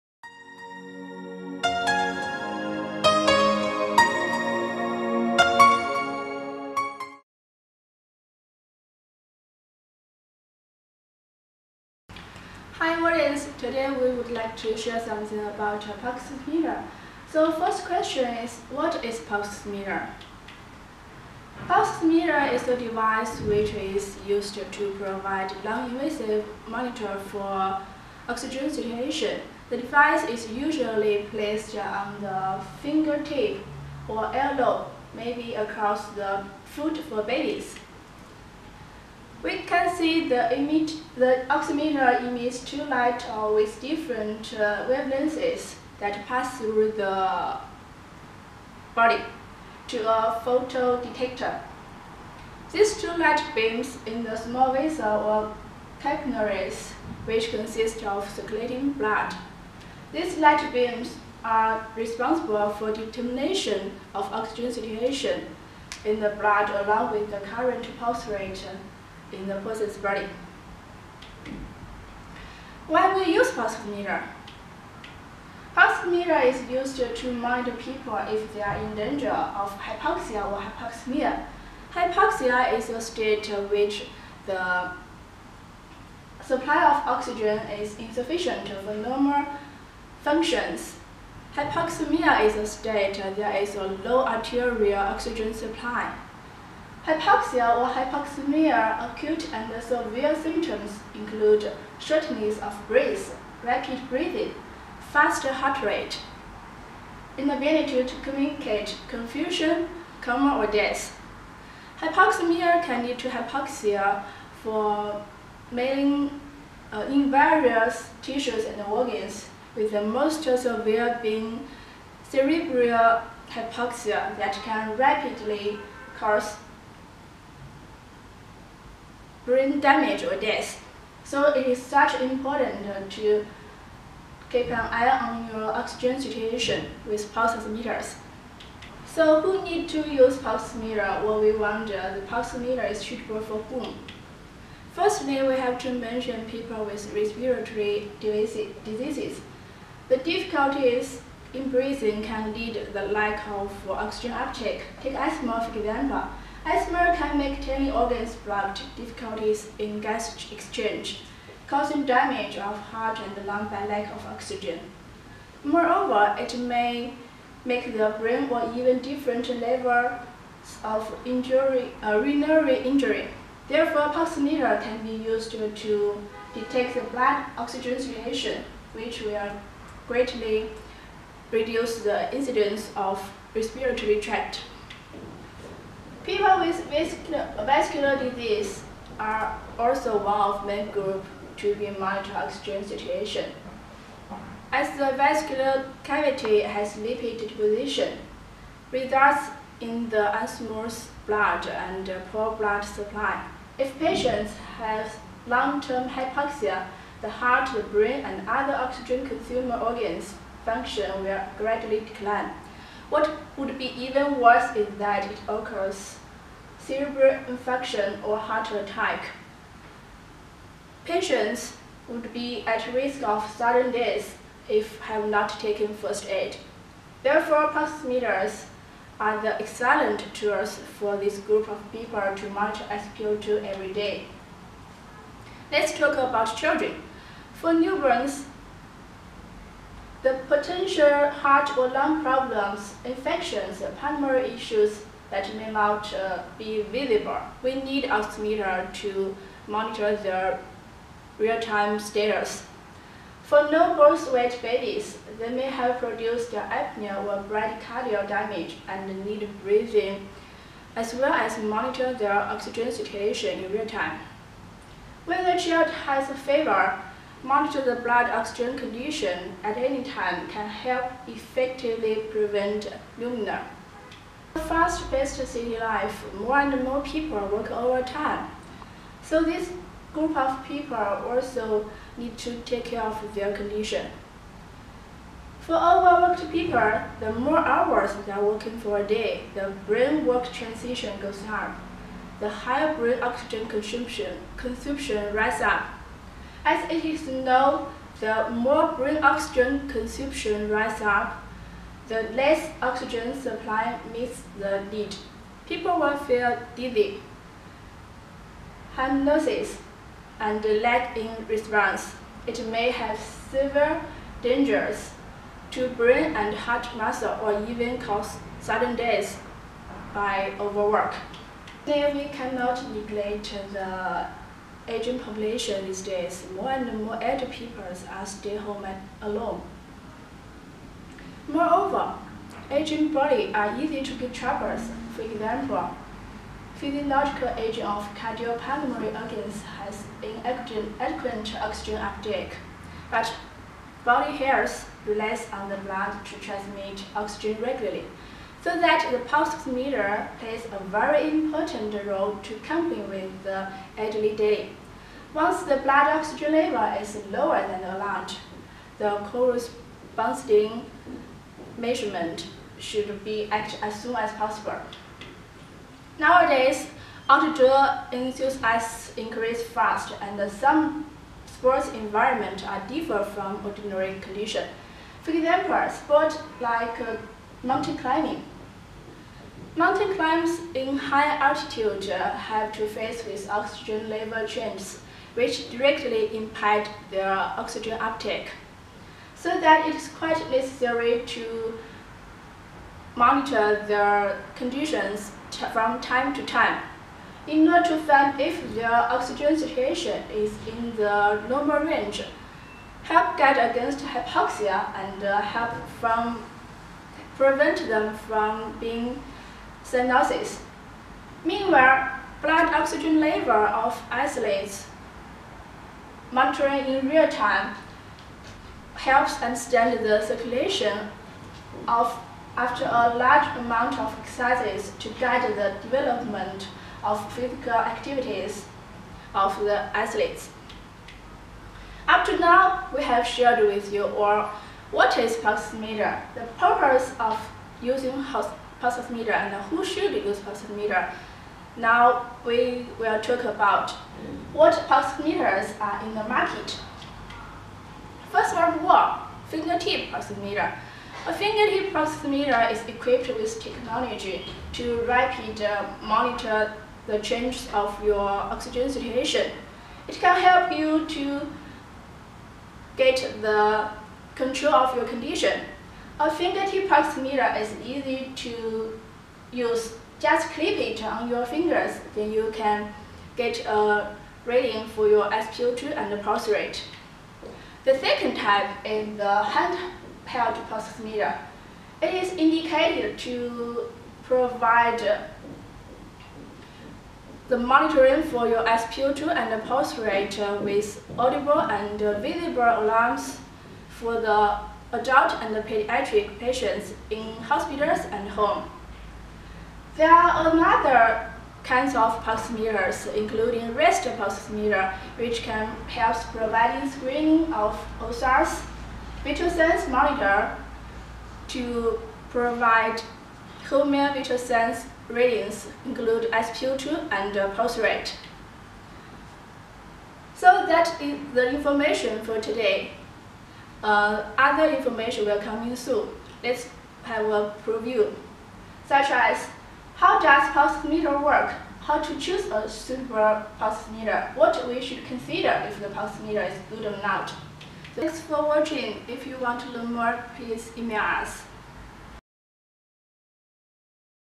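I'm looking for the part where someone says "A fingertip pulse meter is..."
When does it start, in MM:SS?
07:31.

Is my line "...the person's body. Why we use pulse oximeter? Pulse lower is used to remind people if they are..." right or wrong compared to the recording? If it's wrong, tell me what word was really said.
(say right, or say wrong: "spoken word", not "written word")
wrong: "oximeter", not "lower".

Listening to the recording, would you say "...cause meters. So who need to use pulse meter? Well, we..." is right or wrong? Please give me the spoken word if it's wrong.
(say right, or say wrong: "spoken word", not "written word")
wrong: "pulse", not "cause".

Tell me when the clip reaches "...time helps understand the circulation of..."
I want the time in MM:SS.
06:57.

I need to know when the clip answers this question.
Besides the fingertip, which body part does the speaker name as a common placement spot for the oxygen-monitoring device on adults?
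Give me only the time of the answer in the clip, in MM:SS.
00:34.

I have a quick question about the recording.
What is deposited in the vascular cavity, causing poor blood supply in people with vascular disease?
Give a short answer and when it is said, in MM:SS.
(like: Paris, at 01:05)
Lipid, at 03:16.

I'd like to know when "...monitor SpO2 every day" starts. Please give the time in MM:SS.
03:52.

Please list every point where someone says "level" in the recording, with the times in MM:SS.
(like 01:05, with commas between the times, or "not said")
02:49, 05:56, 06:24, 06:53.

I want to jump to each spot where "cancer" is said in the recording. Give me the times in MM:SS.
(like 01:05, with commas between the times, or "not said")
not said.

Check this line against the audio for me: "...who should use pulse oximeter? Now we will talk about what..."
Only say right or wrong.
wrong.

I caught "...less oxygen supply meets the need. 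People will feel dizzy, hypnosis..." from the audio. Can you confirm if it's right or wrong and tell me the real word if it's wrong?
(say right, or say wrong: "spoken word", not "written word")
right.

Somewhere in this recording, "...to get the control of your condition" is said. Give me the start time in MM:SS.
07:41.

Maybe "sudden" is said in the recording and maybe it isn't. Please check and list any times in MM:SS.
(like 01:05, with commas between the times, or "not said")
03:43, 05:18.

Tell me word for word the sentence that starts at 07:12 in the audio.
Up to now, we have shared with you all what is pulse meter?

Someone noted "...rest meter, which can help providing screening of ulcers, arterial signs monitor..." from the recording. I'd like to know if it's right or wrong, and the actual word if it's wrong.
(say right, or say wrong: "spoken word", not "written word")
wrong: "vital", not "arterial".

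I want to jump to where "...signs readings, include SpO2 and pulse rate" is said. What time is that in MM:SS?
08:34.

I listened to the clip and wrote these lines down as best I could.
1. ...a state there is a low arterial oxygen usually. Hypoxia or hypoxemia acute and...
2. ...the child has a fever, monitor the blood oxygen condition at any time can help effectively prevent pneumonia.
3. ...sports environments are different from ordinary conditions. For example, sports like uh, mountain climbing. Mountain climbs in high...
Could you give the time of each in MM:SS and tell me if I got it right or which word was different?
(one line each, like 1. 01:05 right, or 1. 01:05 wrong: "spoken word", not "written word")
1. 01:32 wrong: "supply", not "usually"
2. 04:25 right
3. 06:11 right.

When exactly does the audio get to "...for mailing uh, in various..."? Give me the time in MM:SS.
01:54.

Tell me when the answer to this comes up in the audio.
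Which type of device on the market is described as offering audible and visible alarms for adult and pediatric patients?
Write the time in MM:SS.
07:59.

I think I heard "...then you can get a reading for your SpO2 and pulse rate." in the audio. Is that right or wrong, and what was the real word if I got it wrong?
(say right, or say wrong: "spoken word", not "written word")
right.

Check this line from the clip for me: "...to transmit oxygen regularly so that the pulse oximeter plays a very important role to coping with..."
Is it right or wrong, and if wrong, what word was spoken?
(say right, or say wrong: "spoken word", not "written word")
right.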